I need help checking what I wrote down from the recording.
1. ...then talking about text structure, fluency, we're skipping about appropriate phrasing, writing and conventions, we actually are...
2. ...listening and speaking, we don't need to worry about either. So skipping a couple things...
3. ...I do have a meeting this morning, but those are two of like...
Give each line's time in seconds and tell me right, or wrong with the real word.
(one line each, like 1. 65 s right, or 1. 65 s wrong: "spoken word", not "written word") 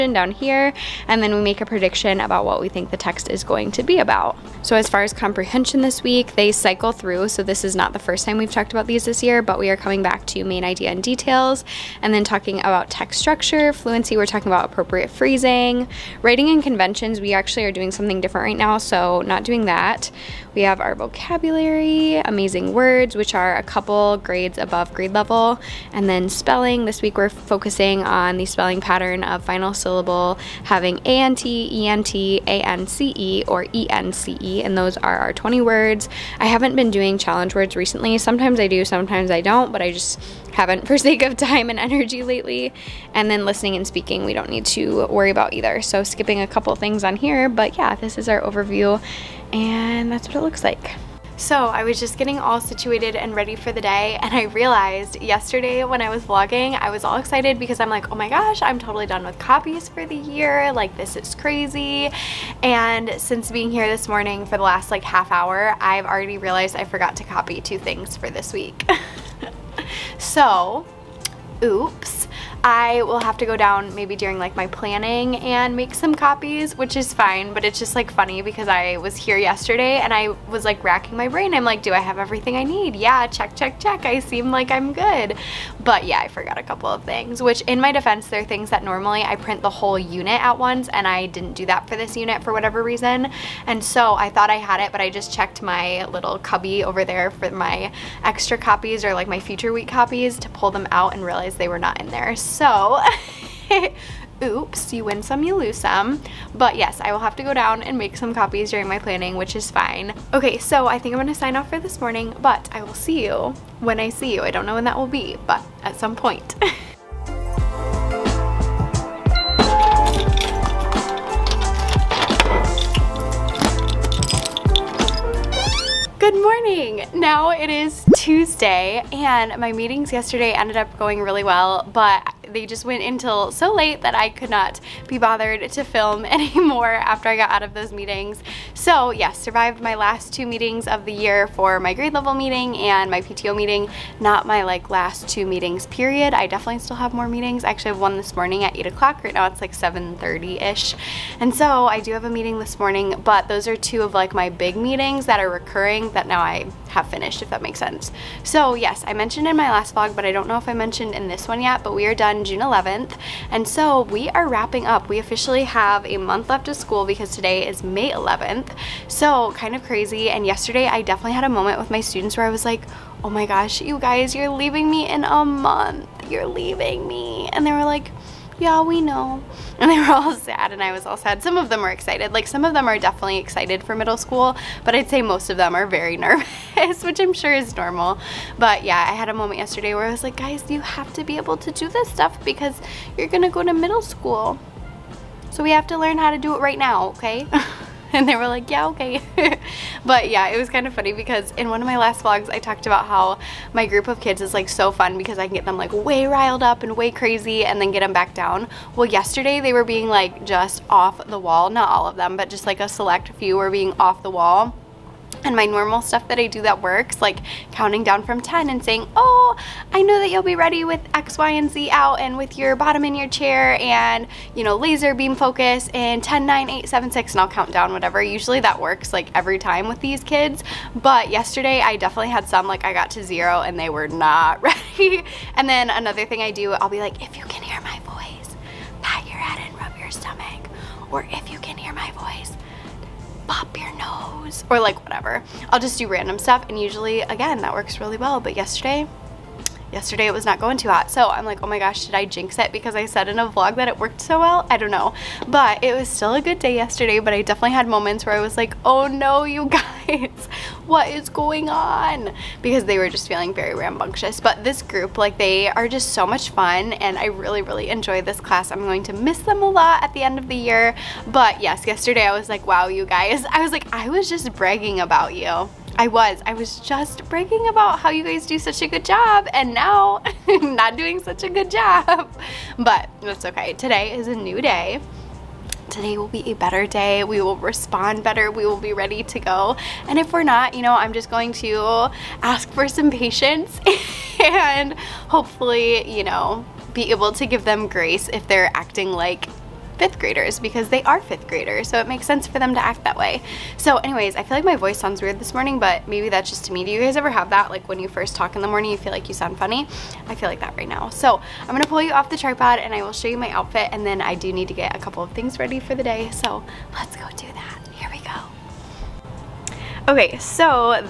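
1. 12 s wrong: "talking", not "skipping"
2. 43 s right
3. 151 s right.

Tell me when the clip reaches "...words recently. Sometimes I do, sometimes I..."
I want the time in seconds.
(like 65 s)
37 s.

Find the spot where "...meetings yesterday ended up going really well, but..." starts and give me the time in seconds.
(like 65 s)
129 s.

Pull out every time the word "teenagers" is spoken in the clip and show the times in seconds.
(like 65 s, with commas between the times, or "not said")
not said.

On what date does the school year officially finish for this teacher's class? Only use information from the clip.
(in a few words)
June 11th.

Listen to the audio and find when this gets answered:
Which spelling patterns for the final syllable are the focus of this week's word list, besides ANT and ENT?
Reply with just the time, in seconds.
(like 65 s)
32 s.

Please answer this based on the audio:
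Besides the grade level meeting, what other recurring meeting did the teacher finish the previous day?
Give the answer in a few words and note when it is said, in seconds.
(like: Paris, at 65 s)
PTO meeting, at 143 s.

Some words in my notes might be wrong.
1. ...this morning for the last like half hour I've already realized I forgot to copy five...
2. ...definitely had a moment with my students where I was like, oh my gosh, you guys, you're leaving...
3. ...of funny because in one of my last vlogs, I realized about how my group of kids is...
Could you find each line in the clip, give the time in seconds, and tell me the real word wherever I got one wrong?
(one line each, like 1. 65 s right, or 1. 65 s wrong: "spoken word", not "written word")
1. 63 s wrong: "two", not "five"
2. 171 s right
3. 200 s wrong: "talked", not "realized".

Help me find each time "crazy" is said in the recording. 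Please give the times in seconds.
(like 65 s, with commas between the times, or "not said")
61 s, 169 s, 207 s.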